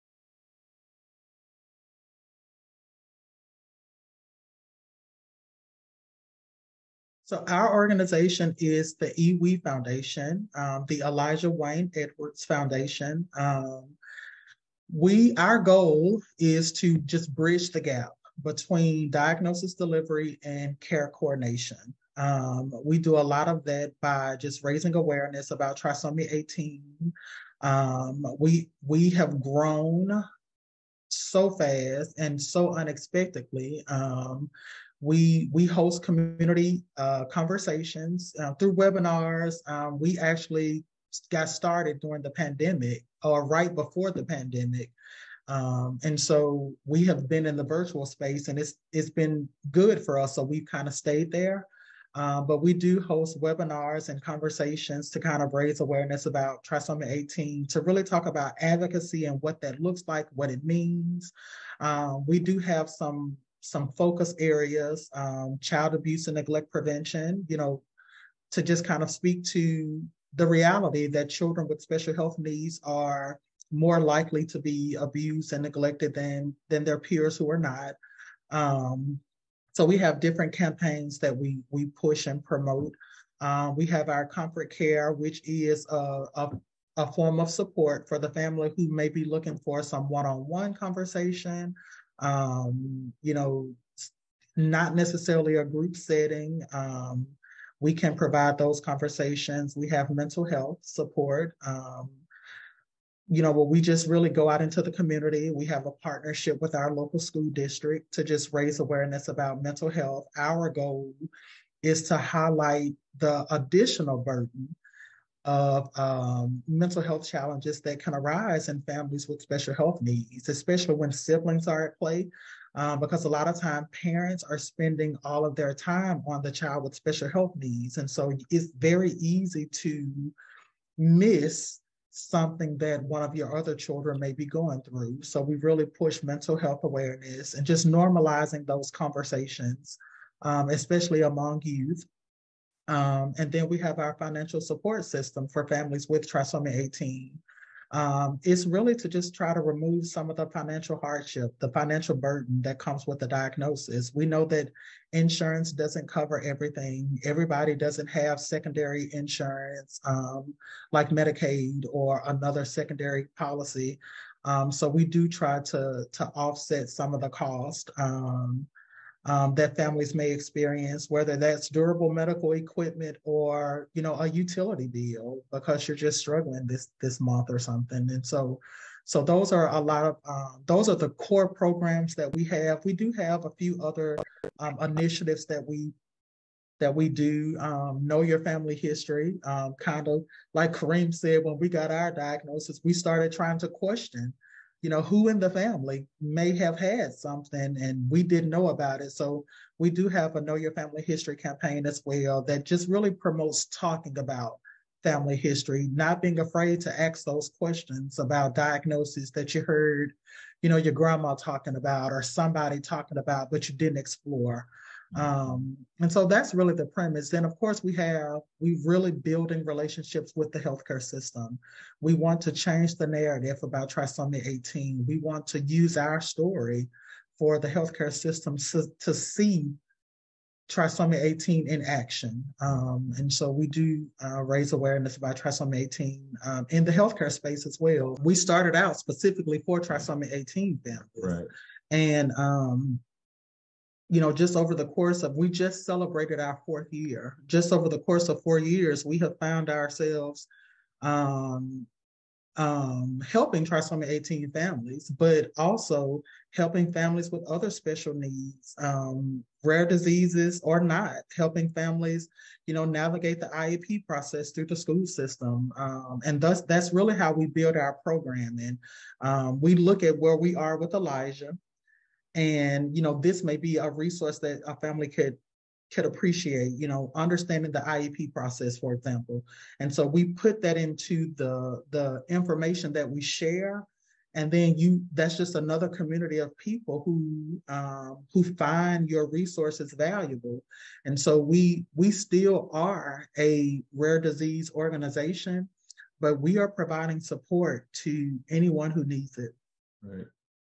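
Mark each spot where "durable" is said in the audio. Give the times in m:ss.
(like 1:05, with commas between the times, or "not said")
2:51.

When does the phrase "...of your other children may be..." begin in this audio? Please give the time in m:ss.
2:13.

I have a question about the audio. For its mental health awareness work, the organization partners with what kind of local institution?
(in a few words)
Local school district.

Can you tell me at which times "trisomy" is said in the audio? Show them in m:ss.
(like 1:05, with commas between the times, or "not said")
0:25, 0:56, 2:26, 3:43, 3:50, 3:55, 3:59, 4:13.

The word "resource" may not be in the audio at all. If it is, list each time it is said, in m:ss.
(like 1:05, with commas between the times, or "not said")
4:33, 4:49.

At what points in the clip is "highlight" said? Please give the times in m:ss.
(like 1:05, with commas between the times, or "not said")
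1:52.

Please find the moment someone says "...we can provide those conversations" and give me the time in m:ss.
1:37.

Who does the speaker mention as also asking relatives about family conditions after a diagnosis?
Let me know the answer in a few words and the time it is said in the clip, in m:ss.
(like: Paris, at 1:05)
Kareem, at 3:10.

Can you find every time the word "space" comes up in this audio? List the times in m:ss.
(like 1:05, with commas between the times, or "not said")
0:48, 3:57.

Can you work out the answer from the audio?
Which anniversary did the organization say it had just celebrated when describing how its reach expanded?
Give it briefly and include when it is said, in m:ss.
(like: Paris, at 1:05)
Fourth year, at 4:06.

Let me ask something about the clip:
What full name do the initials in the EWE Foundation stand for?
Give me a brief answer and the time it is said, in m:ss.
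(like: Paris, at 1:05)
Elijah Wayne Edwards, at 0:11.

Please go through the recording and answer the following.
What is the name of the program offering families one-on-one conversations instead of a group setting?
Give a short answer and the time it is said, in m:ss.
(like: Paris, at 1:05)
Comfort care, at 1:24.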